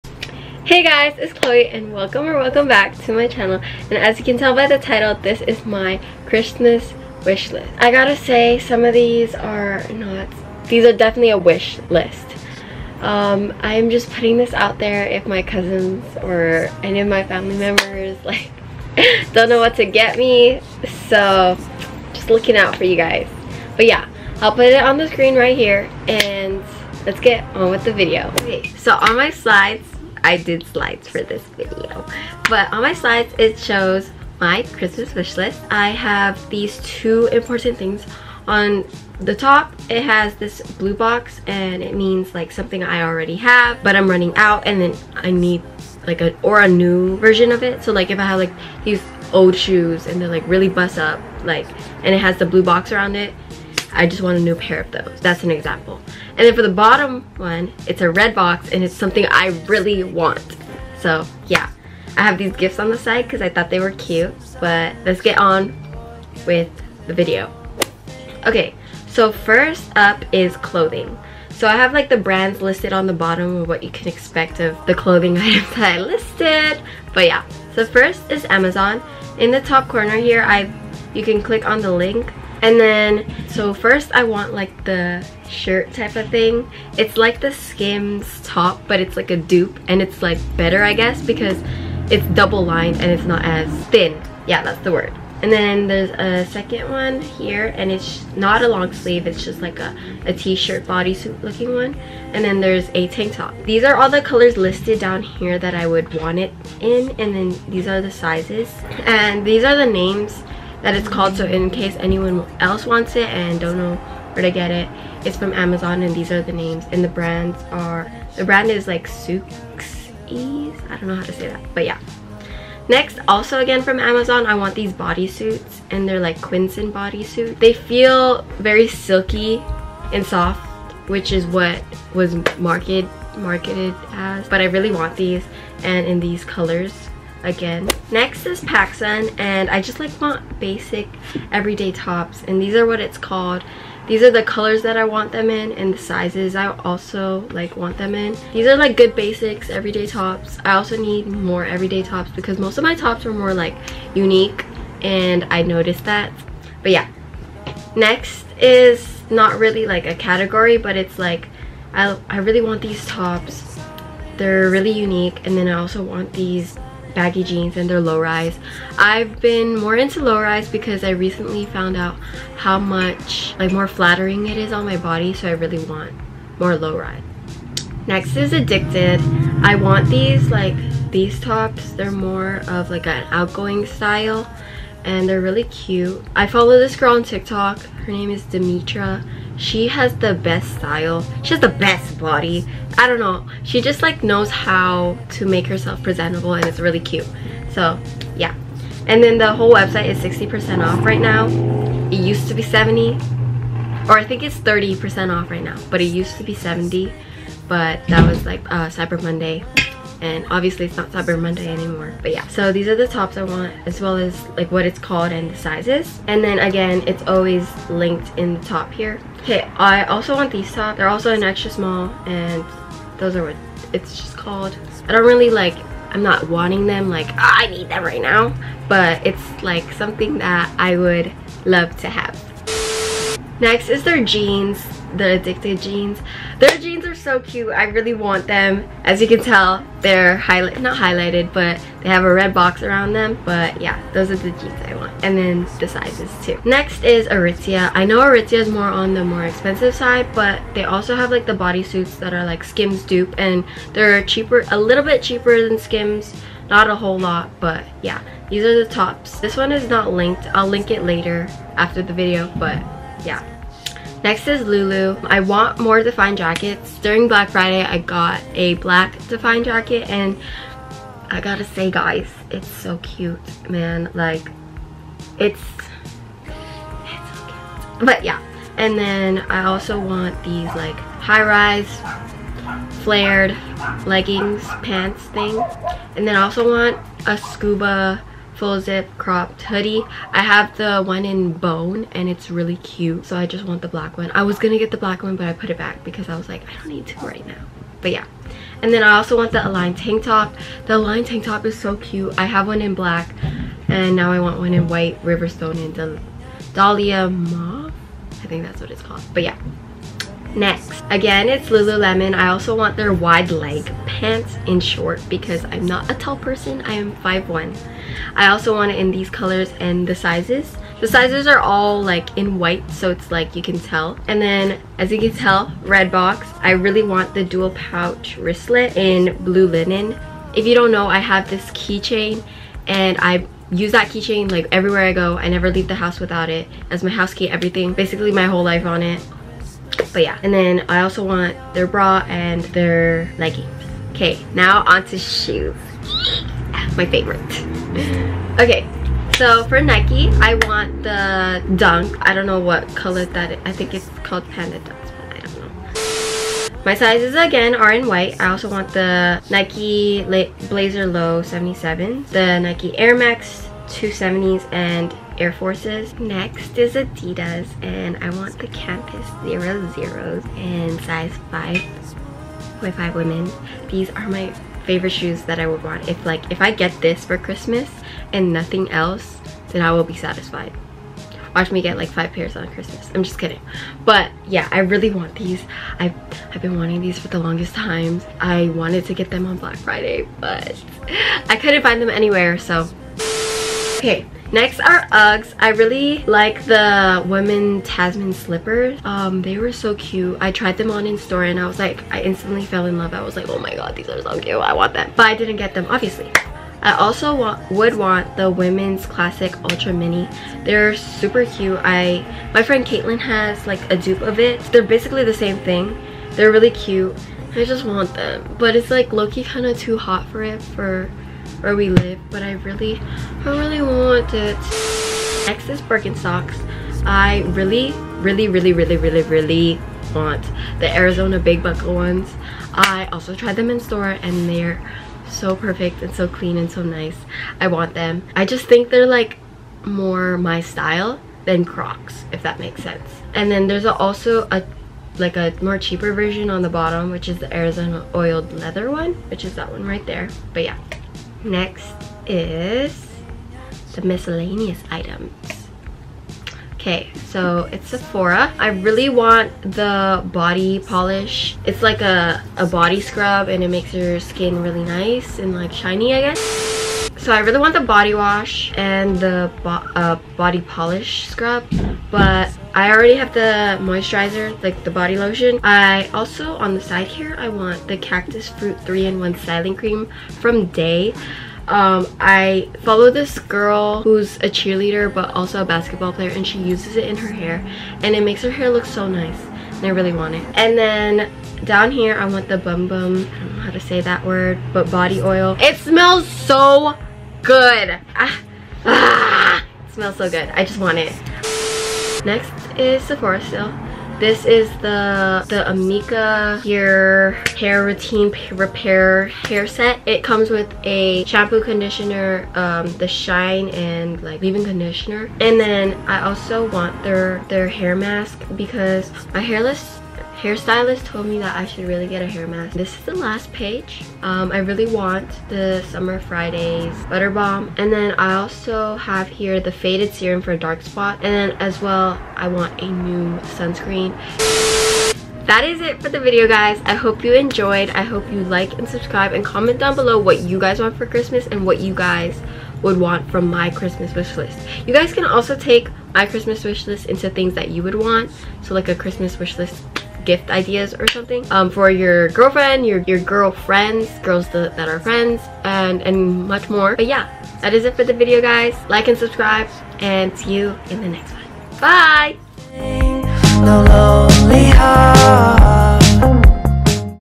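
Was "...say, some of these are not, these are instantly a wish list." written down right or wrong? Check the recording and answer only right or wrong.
wrong.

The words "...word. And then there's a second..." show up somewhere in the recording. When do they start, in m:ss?
1:34.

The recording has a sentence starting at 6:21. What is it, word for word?
Watch me get like five pairs on Christmas.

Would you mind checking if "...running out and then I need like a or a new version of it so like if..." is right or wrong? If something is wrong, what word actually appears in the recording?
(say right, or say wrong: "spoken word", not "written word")
right.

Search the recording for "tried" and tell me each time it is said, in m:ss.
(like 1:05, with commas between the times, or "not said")
6:40, 7:13.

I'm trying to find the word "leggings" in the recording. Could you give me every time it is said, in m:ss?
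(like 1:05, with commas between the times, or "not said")
4:44, 5:43.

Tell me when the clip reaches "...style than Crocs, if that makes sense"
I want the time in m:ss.
7:20.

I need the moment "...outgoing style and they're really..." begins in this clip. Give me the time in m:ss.
3:03.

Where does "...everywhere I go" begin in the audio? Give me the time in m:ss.
5:34.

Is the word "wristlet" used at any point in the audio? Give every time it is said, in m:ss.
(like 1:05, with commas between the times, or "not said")
5:28.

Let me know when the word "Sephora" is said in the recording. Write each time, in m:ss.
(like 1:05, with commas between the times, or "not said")
7:37, 8:23.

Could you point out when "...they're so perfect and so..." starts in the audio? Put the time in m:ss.
7:14.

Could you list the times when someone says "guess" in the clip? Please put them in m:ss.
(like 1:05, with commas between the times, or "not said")
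1:30, 7:46.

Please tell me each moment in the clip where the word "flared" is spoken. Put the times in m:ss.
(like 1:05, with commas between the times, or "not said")
4:43.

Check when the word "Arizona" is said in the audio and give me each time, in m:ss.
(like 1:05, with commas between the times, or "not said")
7:10, 7:27.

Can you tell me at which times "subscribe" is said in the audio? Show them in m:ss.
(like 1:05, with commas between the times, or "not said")
8:58, 9:19.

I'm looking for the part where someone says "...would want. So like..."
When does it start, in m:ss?
9:07.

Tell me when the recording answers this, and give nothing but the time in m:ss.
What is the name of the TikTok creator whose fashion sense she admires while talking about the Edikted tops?
3:08.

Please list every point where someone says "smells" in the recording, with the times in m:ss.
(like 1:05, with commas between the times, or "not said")
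8:15, 8:19.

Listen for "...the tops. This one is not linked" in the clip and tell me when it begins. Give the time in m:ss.
4:18.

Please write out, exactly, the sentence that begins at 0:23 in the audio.
But yeah, I'll put it on the screen right here and let's get on with the video.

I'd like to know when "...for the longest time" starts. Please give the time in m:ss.
6:27.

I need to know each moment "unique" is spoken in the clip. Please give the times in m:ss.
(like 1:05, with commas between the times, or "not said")
2:34, 2:44.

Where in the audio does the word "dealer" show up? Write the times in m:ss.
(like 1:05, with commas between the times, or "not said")
not said.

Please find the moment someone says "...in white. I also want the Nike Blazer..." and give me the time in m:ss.
5:57.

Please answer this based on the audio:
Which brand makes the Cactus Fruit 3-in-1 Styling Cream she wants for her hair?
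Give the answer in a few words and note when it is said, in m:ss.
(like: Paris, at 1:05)
Dae, at 8:00.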